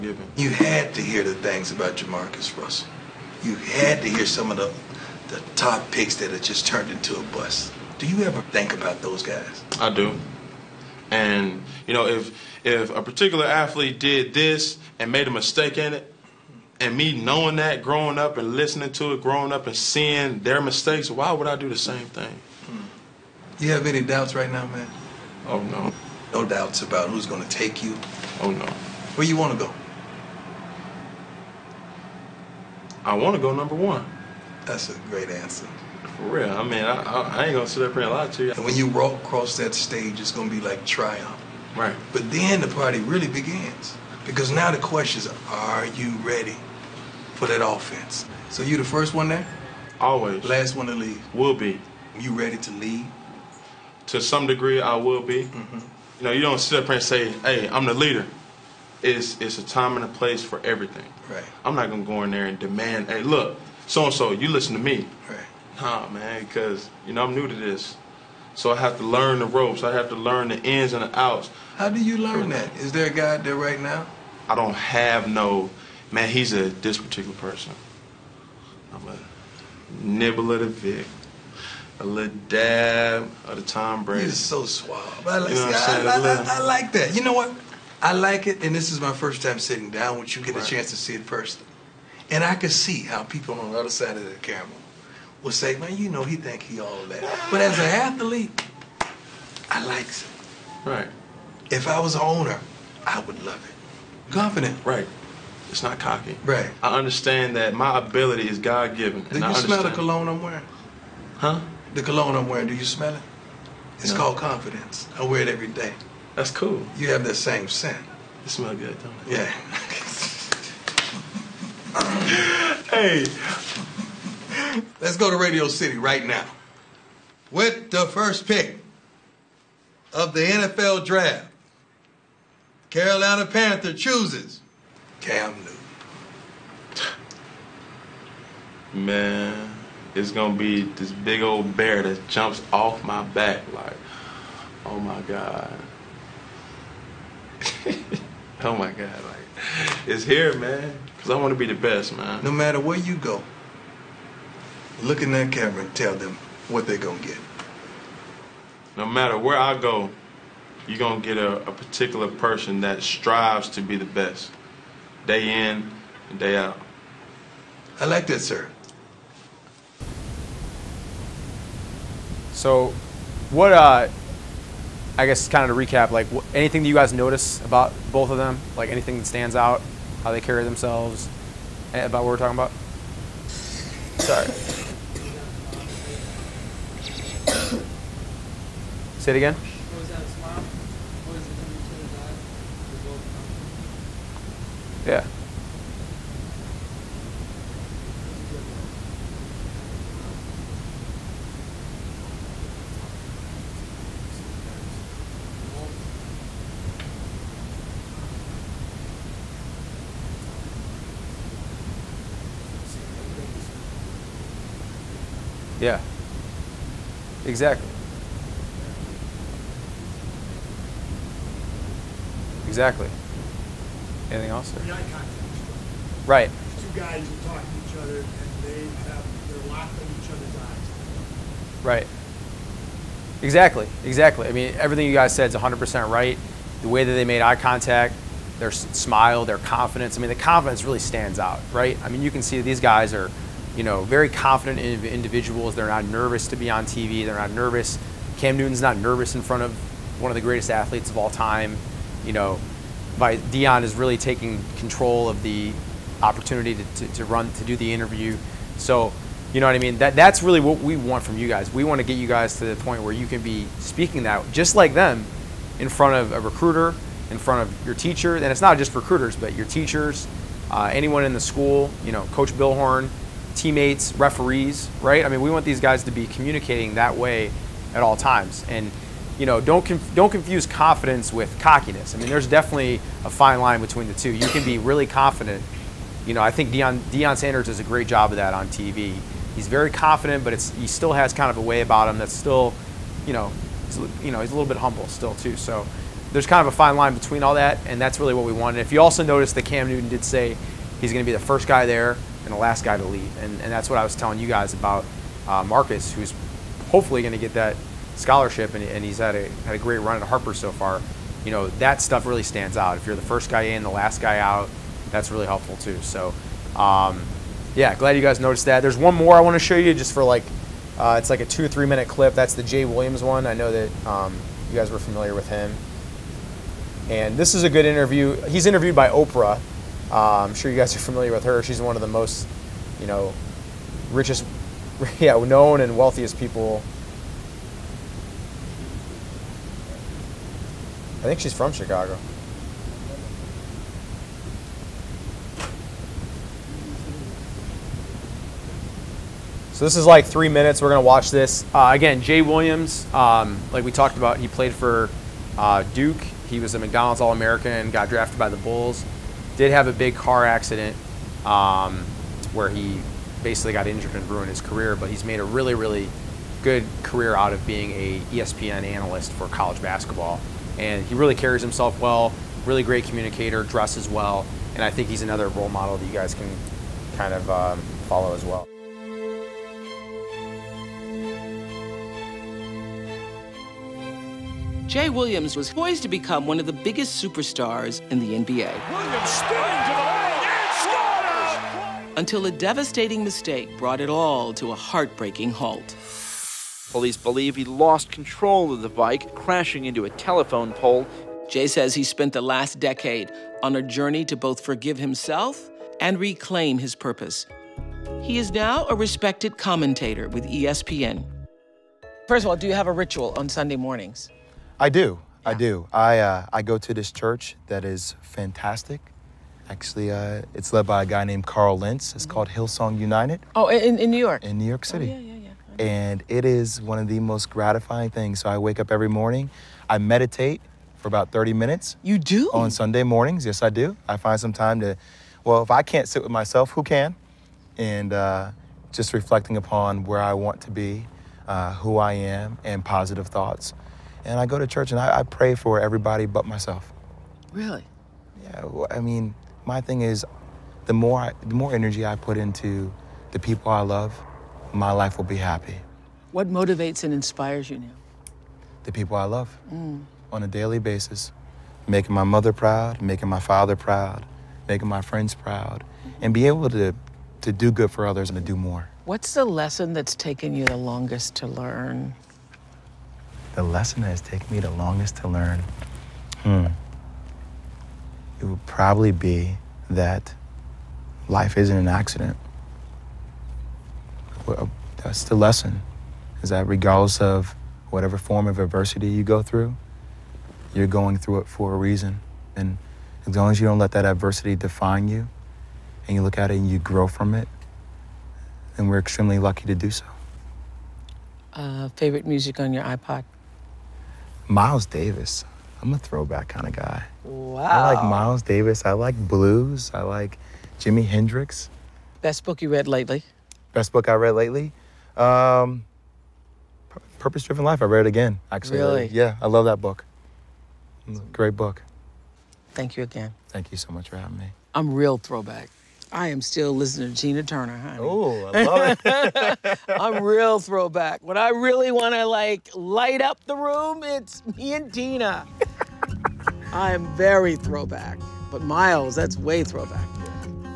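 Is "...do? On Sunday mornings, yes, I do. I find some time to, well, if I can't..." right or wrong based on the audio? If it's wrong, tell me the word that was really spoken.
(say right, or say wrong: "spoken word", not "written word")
right.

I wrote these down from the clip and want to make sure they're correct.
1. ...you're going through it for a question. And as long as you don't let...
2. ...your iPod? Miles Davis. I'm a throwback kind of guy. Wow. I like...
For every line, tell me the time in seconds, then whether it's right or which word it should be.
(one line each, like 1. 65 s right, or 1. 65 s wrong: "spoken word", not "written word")
1. 490 s wrong: "reason", not "question"
2. 502 s right.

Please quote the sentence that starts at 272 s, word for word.
You know, Coach Billhorn teammates, referees, right?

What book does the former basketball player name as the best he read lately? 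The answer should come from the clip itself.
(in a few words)
Purpose Driven Life.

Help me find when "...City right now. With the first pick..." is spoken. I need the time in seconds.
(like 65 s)
125 s.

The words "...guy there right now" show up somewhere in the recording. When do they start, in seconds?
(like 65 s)
73 s.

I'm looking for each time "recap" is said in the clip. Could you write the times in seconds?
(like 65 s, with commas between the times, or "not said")
175 s.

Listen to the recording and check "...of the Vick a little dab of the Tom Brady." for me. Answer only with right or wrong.
right.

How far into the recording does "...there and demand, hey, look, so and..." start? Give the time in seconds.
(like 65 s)
62 s.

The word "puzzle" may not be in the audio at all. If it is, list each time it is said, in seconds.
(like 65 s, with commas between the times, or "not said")
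not said.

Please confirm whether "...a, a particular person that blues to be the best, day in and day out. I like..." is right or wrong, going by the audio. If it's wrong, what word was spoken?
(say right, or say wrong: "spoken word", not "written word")
wrong: "strives", not "blues".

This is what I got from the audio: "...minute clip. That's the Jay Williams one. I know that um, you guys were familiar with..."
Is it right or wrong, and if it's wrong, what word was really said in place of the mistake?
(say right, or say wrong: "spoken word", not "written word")
right.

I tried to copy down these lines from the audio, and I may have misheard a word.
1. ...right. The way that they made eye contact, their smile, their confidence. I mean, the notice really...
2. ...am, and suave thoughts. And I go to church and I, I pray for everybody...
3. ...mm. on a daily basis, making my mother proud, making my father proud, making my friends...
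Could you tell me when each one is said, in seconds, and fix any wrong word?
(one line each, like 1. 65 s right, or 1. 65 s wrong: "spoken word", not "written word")
1. 236 s wrong: "confidence", not "notice"
2. 442 s wrong: "positive", not "suave"
3. 459 s right.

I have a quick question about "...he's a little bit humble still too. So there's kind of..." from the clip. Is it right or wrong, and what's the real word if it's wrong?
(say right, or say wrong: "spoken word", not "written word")
right.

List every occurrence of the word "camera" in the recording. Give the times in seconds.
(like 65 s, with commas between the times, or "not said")
94 s, 155 s.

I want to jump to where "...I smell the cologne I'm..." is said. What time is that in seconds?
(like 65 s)
109 s.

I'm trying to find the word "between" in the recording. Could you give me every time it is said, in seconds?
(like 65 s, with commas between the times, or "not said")
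283 s, 297 s.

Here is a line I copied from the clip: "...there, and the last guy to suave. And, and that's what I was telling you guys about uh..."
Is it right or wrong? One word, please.
wrong.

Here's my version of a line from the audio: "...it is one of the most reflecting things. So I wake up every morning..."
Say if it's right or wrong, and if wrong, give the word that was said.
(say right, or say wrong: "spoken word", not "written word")
wrong: "gratifying", not "reflecting".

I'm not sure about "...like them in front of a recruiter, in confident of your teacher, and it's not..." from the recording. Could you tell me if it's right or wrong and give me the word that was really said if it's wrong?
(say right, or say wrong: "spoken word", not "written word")
wrong: "front", not "confident".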